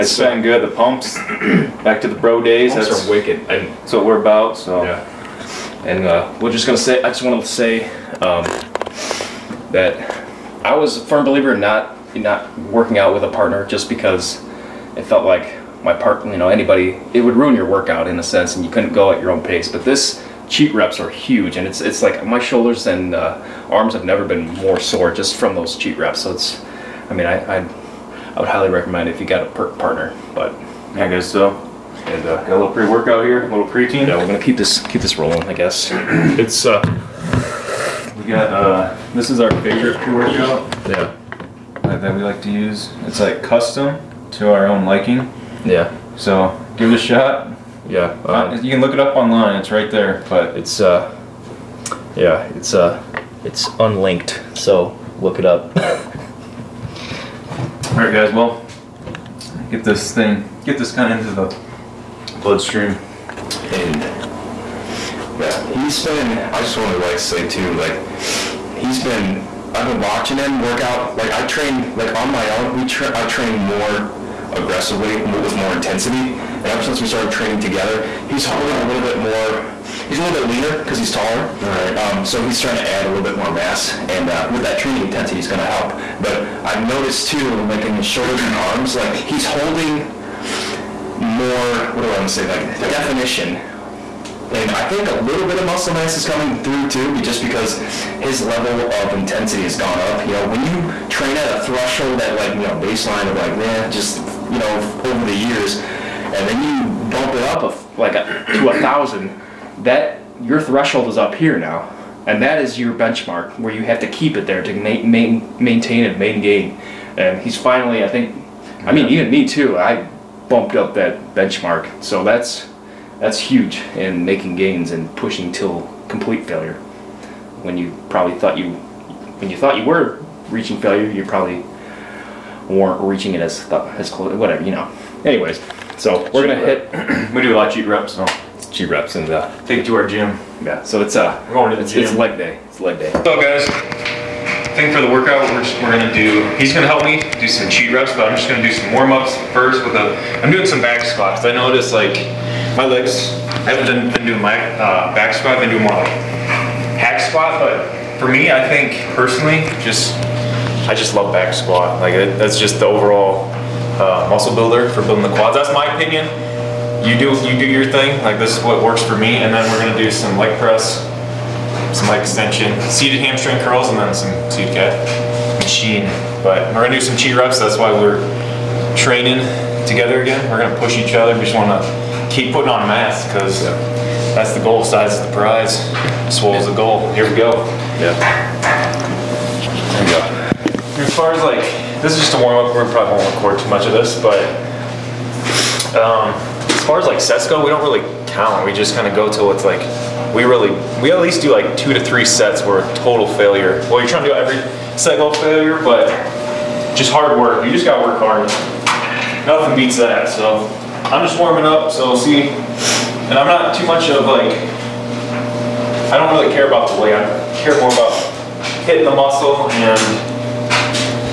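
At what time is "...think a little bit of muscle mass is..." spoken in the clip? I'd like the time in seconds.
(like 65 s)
94 s.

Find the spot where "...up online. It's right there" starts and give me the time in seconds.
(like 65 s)
48 s.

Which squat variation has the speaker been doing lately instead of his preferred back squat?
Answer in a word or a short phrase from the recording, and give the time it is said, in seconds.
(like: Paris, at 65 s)
hack squat, at 156 s.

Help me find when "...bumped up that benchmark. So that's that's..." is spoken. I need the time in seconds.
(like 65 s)
120 s.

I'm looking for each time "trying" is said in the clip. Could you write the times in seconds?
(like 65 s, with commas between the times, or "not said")
82 s, 204 s.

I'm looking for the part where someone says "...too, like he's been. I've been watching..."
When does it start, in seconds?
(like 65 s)
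67 s.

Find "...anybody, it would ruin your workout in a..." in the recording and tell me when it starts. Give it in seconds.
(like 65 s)
16 s.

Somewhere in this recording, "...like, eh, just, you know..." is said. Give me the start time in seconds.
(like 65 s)
103 s.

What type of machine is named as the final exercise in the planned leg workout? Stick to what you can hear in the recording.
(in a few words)
seated calf machine.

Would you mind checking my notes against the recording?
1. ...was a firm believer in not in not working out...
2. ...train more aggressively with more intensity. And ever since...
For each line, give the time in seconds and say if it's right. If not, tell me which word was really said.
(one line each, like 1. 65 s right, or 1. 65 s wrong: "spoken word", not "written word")
1. 10 s right
2. 73 s right.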